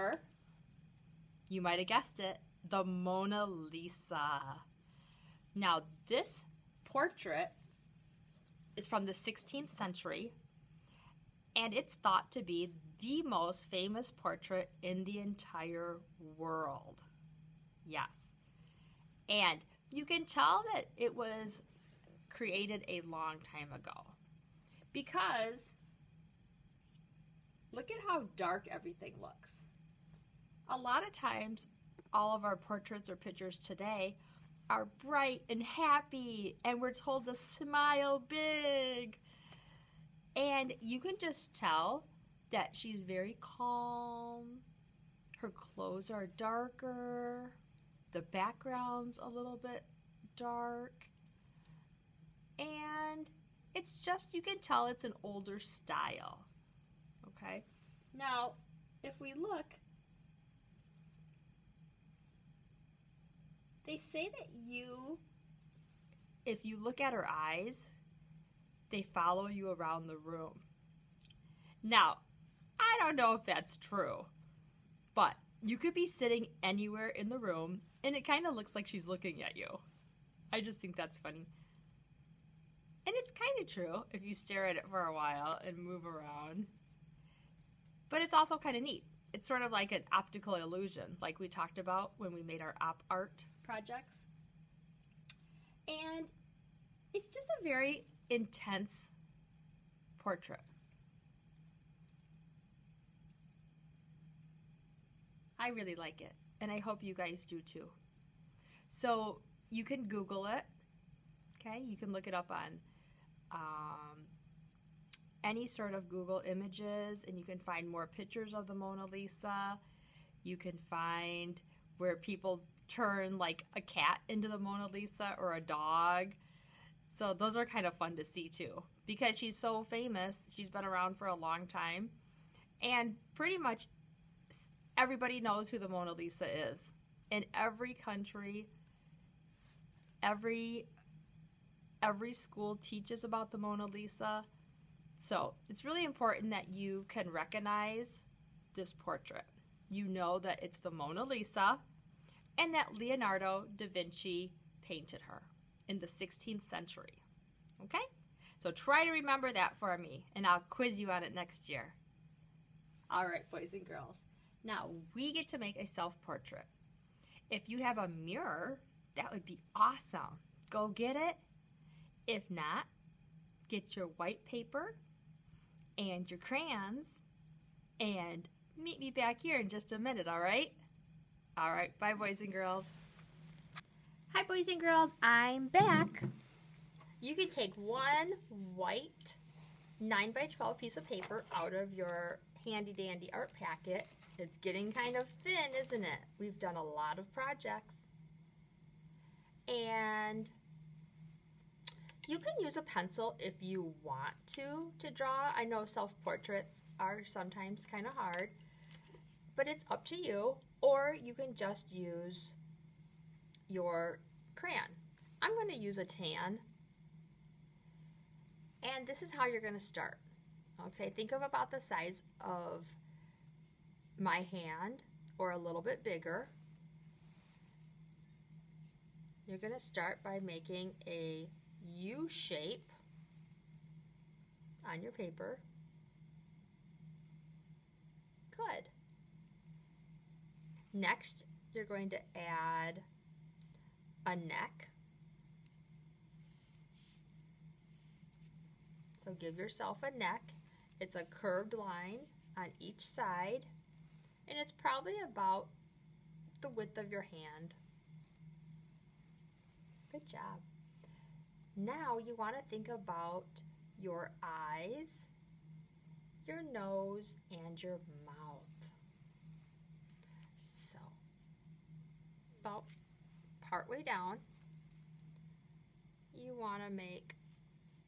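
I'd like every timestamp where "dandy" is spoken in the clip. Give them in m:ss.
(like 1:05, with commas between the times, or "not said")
3:12.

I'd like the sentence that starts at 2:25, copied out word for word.
So, it's really important that you can recognize this portrait.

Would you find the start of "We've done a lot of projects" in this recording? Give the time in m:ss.
3:16.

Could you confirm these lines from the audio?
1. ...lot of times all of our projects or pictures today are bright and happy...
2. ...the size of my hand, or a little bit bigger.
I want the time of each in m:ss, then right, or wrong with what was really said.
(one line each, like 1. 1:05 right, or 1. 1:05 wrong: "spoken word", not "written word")
1. 0:30 wrong: "portraits", not "projects"
2. 3:41 right.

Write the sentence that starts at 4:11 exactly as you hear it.
It's a curved line on each side and it's probably about the width of your hand.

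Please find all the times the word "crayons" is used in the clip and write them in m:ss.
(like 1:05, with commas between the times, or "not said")
2:56, 3:34.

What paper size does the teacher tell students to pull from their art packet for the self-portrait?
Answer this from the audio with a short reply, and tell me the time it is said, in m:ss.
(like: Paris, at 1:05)
9 by 12, at 3:10.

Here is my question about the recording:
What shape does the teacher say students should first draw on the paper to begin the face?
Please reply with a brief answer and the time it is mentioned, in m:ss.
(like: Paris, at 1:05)
a U shape, at 3:51.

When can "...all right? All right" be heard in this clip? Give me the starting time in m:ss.
3:00.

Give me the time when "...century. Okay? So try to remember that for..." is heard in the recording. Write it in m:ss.
2:36.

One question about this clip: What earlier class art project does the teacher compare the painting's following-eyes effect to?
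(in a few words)
op art projects.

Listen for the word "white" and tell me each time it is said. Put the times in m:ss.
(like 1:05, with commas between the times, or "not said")
2:54, 3:08.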